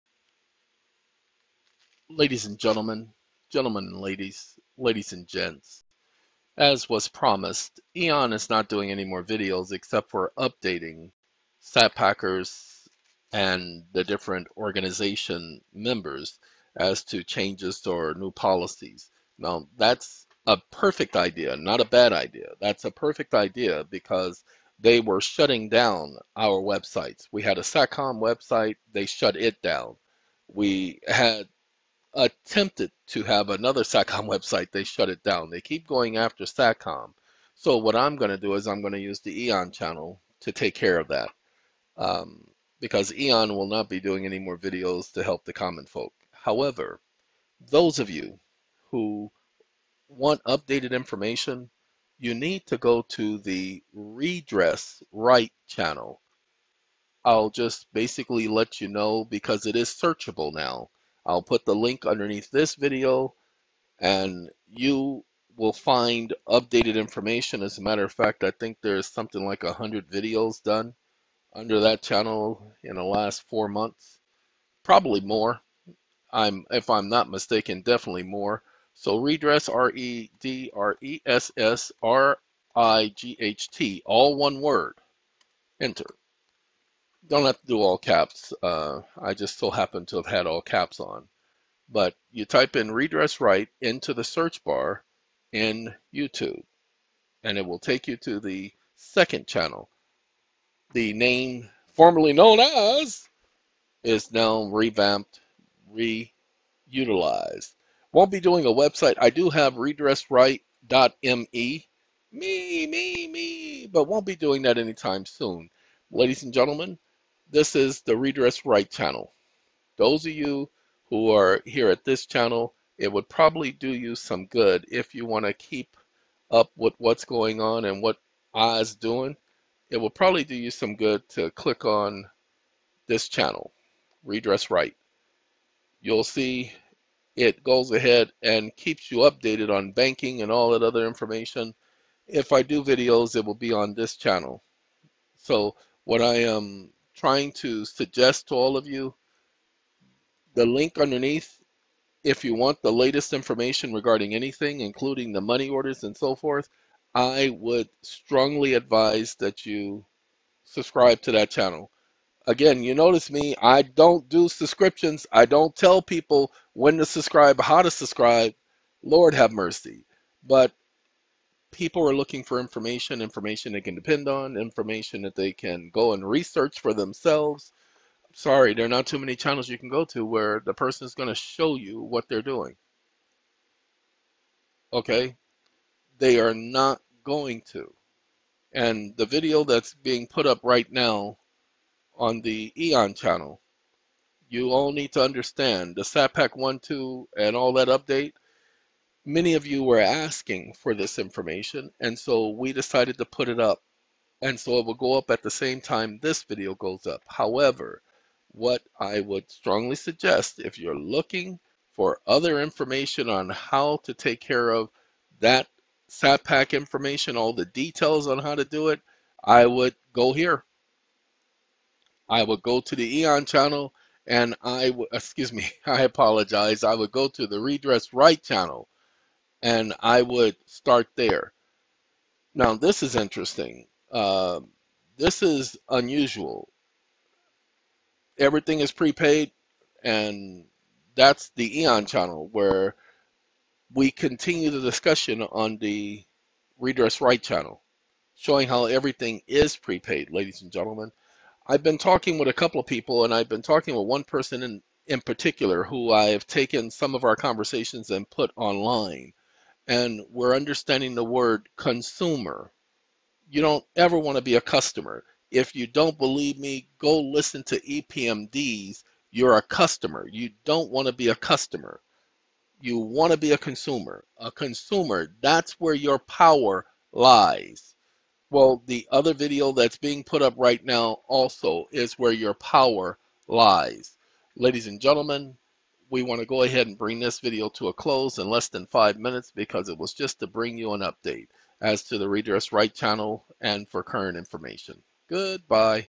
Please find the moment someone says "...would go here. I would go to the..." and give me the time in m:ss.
3:39.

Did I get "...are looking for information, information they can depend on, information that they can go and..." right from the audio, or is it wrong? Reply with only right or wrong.
right.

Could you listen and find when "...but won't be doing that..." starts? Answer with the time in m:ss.
1:53.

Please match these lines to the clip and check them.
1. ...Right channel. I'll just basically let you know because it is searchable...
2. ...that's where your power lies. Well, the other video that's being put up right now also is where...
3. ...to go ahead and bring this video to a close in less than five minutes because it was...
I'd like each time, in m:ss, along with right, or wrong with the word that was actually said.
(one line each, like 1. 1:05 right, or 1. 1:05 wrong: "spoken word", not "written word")
1. 0:55 right
2. 4:35 right
3. 4:46 right.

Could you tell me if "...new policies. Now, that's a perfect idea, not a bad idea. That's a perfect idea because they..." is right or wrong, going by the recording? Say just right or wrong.
right.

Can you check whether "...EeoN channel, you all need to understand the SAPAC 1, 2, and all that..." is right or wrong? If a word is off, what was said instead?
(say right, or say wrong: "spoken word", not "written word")
right.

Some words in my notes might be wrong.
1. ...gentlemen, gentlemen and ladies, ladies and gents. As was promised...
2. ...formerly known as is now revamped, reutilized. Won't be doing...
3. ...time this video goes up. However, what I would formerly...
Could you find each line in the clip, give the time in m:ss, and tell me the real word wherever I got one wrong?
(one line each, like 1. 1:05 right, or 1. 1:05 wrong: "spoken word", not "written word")
1. 0:02 right
2. 1:41 right
3. 3:25 wrong: "strongly", not "formerly".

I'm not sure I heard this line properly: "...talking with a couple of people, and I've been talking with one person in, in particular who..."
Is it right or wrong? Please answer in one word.
right.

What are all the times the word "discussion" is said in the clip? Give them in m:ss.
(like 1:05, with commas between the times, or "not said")
4:04.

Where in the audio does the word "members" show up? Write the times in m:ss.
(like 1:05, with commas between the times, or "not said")
0:15.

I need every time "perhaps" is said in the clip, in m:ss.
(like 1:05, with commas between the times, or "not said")
not said.